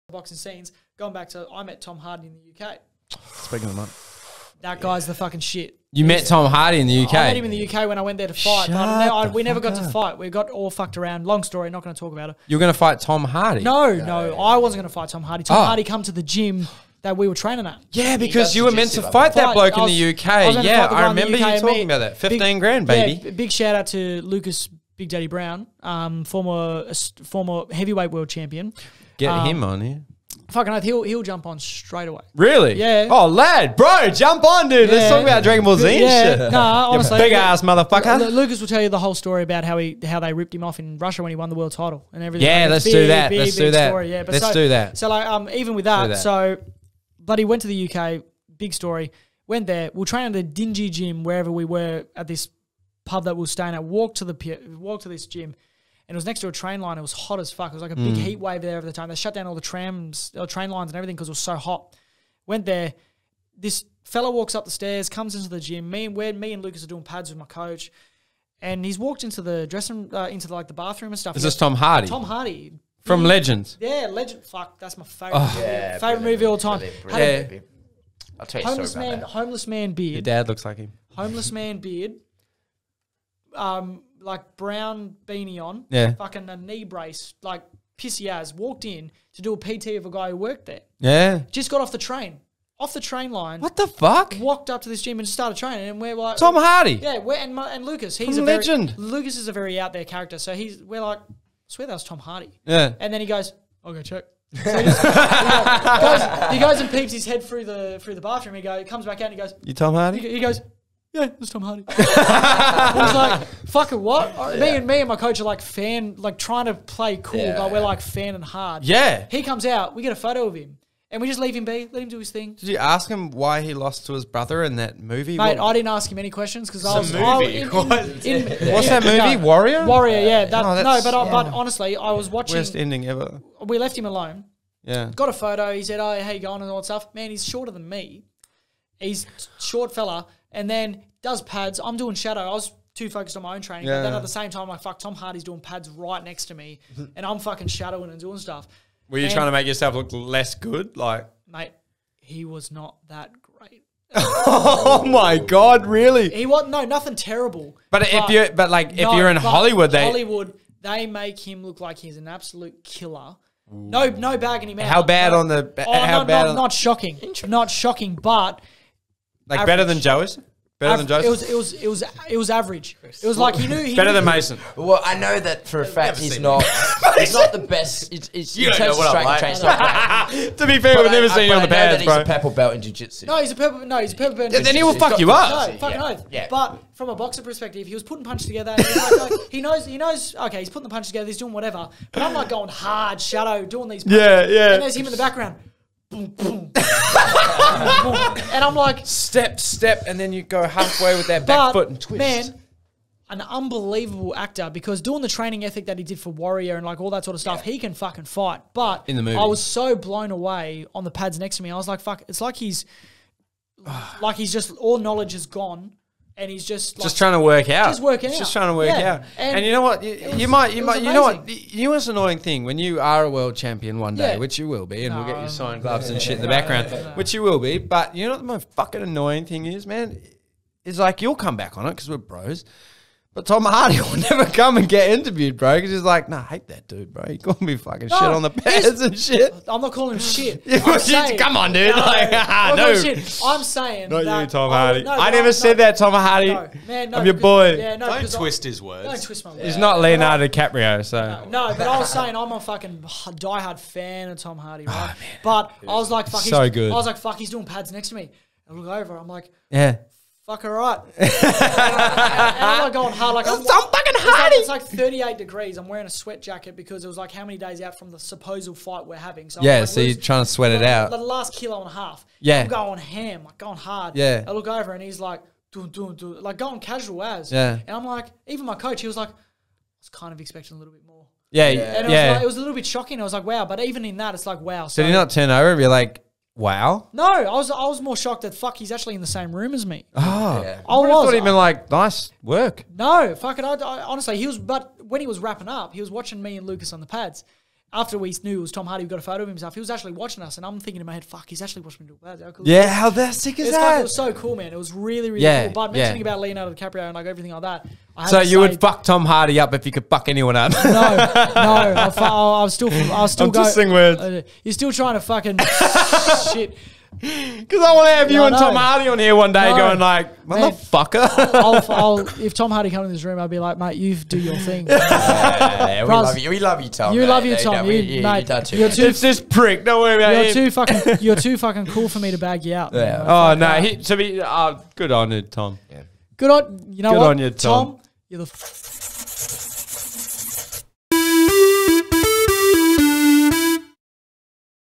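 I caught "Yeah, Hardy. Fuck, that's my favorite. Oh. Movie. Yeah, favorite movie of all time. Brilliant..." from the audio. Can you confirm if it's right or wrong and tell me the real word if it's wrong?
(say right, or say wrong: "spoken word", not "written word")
wrong: "Legend", not "Hardy".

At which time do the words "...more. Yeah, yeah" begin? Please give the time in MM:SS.
04:41.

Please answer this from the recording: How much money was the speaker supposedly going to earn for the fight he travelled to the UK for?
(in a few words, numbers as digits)
15 grand.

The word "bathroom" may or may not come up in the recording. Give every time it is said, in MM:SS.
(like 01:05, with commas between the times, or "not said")
01:10, 01:48.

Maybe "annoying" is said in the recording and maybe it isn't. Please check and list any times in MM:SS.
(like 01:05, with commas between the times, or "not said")
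03:42, 03:49.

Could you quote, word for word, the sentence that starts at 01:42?
Yeah, and then he goes, I'll go check.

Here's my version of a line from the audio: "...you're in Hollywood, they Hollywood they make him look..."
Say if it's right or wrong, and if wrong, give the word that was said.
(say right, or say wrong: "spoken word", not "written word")
right.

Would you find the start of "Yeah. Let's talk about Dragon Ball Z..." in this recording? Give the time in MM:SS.
00:34.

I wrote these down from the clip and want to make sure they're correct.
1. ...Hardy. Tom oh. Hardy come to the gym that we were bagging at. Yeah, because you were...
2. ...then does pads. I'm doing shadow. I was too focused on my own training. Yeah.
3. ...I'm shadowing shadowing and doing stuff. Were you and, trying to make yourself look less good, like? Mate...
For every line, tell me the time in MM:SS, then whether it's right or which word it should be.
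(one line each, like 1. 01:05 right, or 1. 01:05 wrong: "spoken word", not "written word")
1. 00:15 wrong: "training", not "bagging"
2. 02:20 right
3. 02:27 wrong: "fucking", not "shadowing".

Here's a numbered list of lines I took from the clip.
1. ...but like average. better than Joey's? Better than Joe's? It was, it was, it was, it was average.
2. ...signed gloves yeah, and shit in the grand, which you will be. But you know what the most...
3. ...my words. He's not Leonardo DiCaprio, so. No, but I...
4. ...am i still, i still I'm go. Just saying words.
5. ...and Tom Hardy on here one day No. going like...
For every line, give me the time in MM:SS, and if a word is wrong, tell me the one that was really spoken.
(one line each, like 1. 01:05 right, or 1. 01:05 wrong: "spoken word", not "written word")
1. 02:48 right
2. 03:45 wrong: "background", not "grand"
3. 04:09 right
4. 05:11 right
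5. 05:18 right.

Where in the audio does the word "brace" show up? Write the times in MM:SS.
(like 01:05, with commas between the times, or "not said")
01:26.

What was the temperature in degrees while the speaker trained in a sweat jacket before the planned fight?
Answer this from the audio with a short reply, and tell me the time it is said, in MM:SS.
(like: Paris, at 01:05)
38, at 04:24.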